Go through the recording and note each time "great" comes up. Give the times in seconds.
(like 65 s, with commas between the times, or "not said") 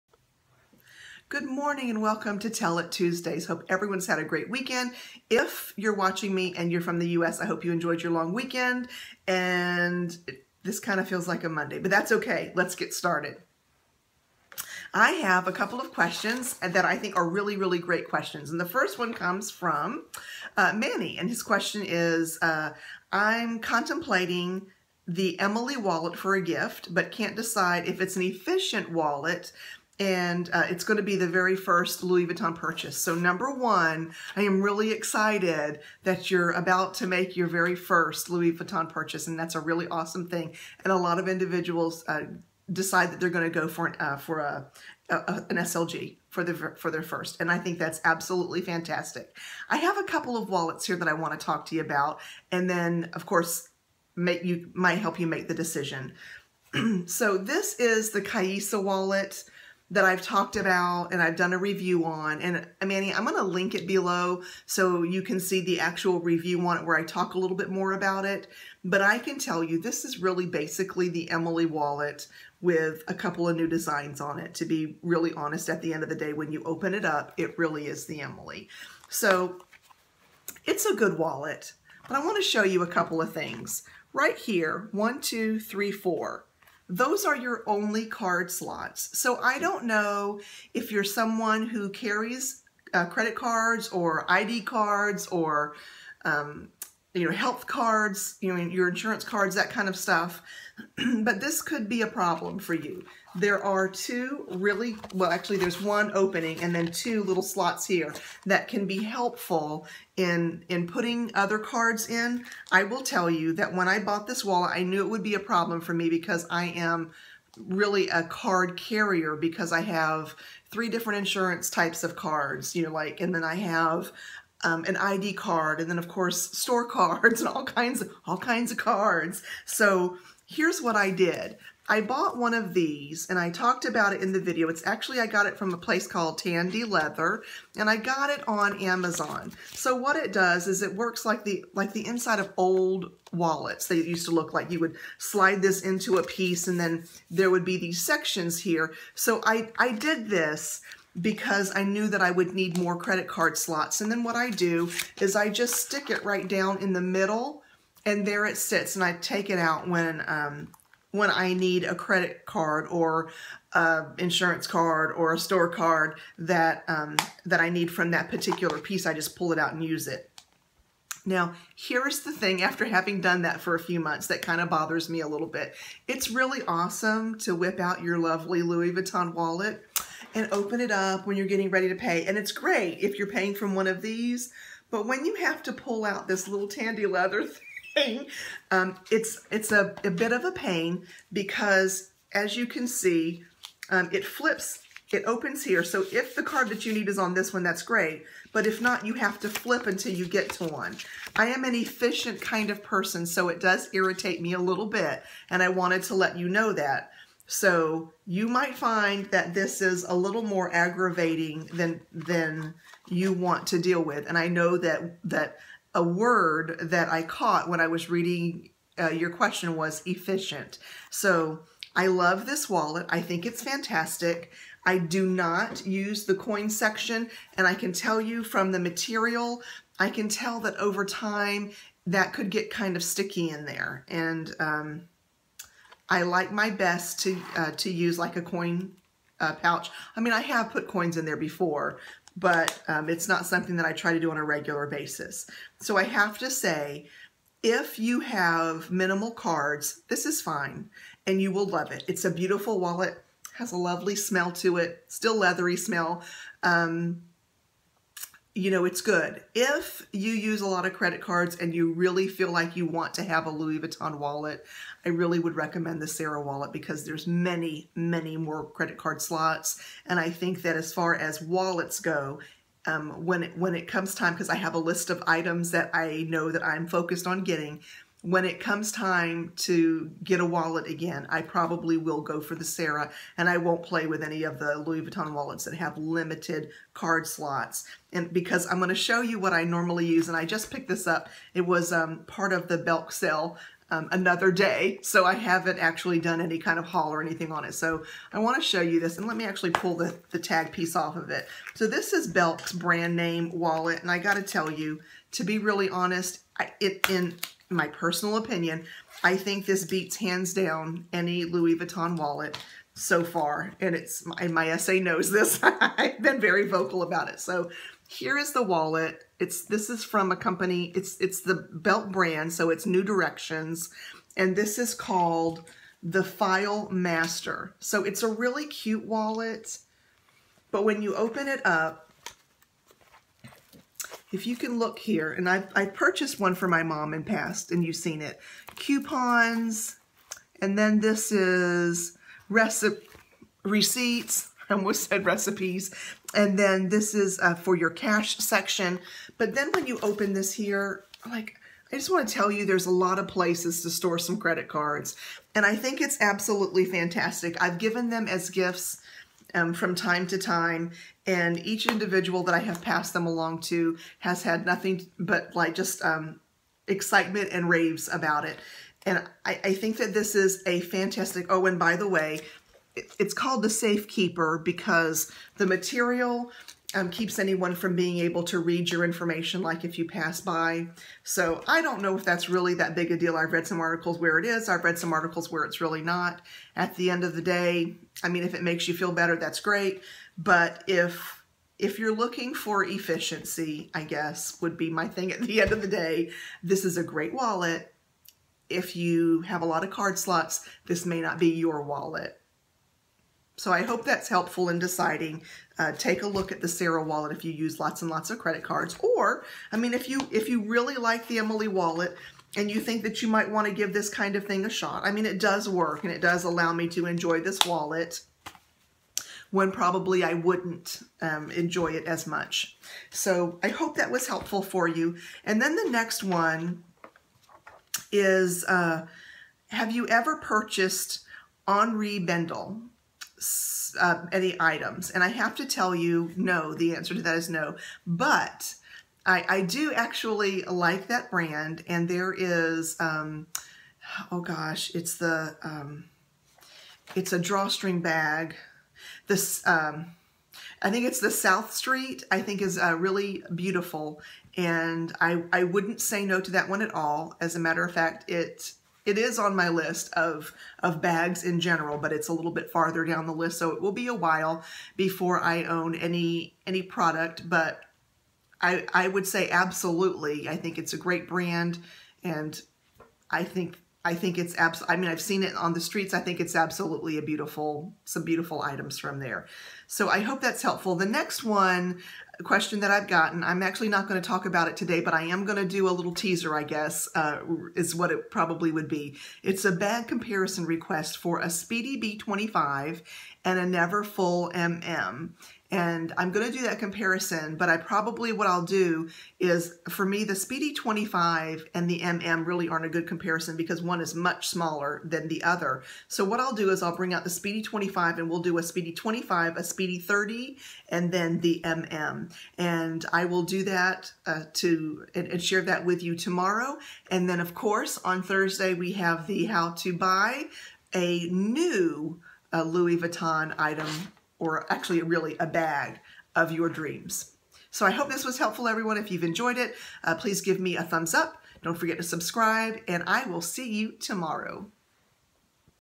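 4 s, 17 s, 182 s, 197 s, 389 s, 397 s, 470 s.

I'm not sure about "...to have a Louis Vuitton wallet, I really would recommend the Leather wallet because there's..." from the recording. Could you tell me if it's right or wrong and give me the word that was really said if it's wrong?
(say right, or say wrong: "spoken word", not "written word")
wrong: "Sarah", not "Leather".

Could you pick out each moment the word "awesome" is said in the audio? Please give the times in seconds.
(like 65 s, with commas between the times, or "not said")
39 s, 176 s.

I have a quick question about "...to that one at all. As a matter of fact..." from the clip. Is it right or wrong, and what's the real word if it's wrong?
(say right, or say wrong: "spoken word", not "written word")
right.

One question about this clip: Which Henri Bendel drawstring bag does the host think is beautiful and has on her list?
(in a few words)
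South Street.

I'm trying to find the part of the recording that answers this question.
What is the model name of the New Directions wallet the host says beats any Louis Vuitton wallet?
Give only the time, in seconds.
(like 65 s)
326 s.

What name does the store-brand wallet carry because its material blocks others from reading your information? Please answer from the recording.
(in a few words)
Safekeeper.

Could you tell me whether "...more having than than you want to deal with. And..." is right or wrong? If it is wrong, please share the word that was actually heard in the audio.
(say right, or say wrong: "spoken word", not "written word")
wrong: "aggravating", not "having".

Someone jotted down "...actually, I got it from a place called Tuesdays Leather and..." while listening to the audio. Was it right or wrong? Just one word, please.
wrong.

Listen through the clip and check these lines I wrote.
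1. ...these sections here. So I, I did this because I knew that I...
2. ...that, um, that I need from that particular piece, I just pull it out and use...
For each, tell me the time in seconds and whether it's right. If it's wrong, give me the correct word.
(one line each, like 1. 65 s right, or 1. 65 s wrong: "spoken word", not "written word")
1. 147 s right
2. 166 s right.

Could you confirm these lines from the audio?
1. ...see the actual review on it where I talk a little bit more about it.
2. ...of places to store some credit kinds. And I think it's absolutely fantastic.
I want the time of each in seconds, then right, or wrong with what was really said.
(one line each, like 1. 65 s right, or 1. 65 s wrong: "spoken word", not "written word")
1. 65 s right
2. 353 s wrong: "cards", not "kinds".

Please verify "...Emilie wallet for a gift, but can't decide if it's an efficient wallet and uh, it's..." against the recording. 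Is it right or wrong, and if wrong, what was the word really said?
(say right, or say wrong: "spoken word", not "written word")
right.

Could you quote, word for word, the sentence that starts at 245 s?
So I have to say, if you have minimal cards, this is fine, and you will love it.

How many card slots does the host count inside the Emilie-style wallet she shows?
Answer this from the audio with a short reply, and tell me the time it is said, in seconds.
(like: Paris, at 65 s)
4, at 85 s.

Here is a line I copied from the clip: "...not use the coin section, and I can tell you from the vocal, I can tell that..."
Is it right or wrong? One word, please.
wrong.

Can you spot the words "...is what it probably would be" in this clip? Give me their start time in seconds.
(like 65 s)
487 s.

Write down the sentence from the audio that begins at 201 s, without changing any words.
I am an efficient kind of person, so it does irritate me a little bit.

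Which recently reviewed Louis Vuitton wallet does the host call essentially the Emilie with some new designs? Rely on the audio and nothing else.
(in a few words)
Kaisa wallet.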